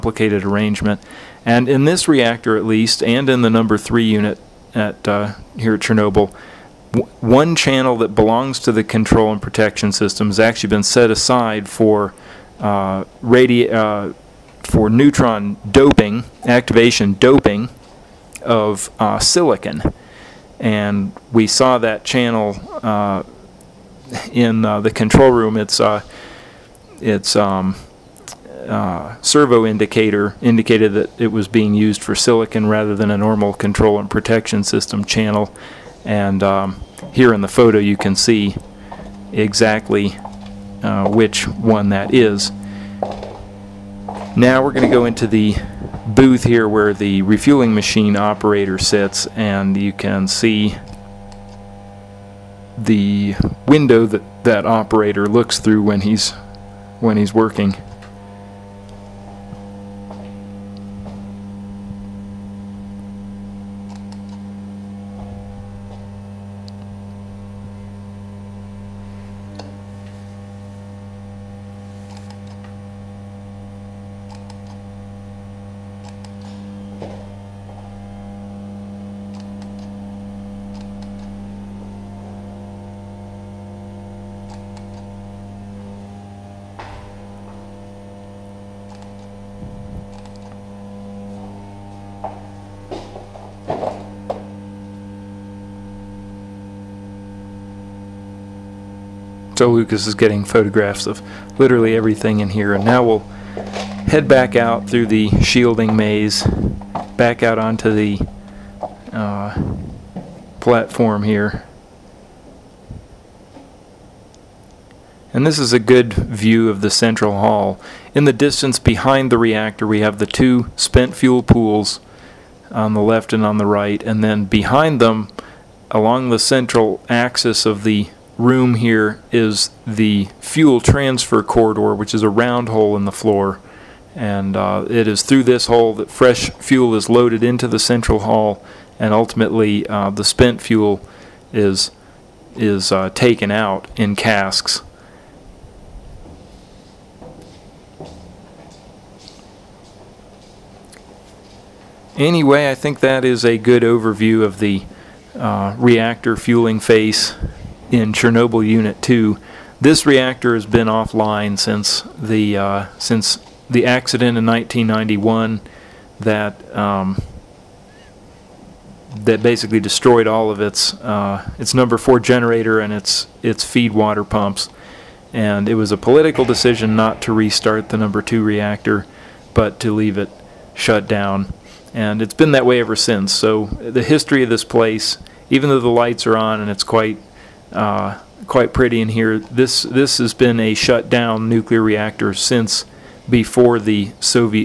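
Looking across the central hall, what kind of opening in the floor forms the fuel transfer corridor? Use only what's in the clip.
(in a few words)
A round hole.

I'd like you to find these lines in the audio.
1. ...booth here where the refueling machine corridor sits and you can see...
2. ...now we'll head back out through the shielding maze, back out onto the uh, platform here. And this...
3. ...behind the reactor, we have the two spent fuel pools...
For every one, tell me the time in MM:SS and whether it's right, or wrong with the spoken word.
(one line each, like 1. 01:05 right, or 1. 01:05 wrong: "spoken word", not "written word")
1. 00:46 wrong: "operator", not "corridor"
2. 01:42 right
3. 01:58 right.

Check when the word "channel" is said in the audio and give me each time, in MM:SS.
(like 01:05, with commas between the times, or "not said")
00:07, 00:22, 00:35.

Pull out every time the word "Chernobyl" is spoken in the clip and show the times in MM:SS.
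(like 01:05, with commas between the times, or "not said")
00:05, 02:38.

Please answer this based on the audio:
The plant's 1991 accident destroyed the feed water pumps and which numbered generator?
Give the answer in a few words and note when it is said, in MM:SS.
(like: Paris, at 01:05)
Number four, at 02:51.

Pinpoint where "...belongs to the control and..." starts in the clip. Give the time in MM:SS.
00:08.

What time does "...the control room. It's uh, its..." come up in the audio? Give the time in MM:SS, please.
00:24.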